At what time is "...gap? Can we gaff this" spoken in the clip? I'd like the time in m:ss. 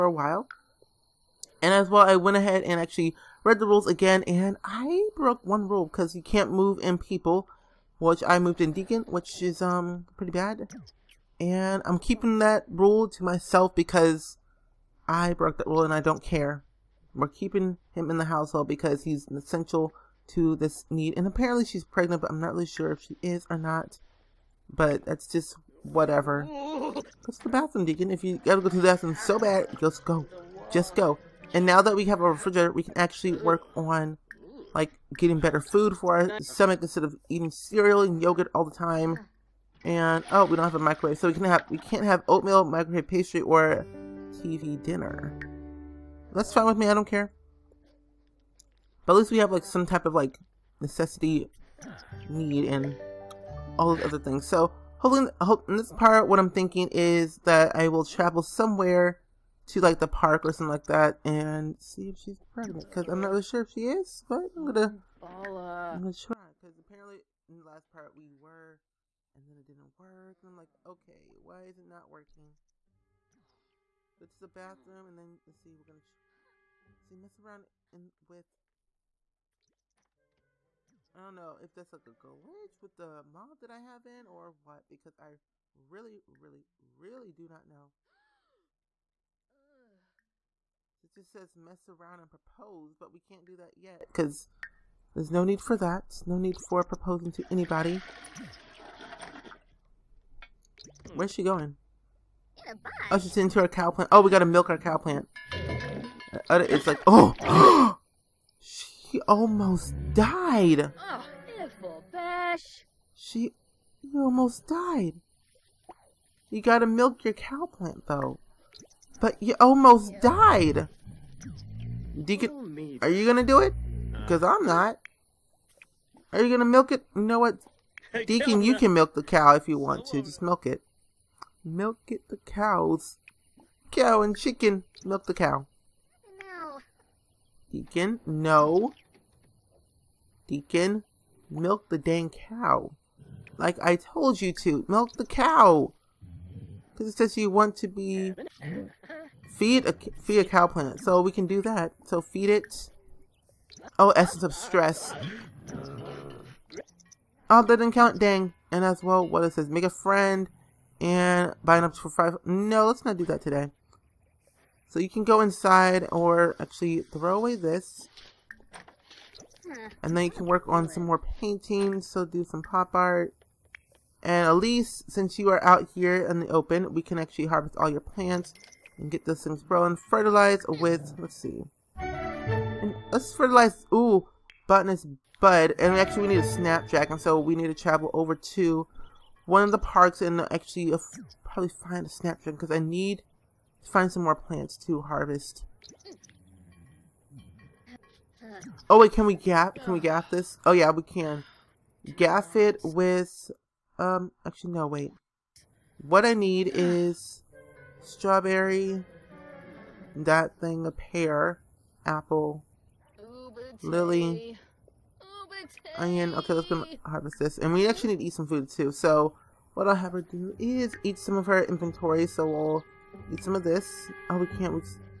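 3:19.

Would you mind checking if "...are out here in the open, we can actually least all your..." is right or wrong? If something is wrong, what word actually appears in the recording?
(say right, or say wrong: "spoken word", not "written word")
wrong: "harvest", not "least".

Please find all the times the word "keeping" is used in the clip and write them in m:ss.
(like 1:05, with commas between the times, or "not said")
0:11, 0:17.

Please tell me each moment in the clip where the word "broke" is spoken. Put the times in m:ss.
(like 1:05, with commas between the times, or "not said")
0:05, 0:15.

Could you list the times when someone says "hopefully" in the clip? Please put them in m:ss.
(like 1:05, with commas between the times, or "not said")
0:54.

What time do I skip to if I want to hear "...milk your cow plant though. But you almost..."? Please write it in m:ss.
1:56.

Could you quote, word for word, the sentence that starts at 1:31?
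It just says mess around and propose, but we can't do that yet because there's no need for that.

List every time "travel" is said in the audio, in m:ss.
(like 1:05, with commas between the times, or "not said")
0:58, 3:07.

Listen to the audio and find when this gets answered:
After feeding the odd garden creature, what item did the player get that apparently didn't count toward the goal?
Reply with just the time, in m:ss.
2:34.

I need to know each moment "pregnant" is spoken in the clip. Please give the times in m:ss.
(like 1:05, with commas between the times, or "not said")
0:21, 1:02.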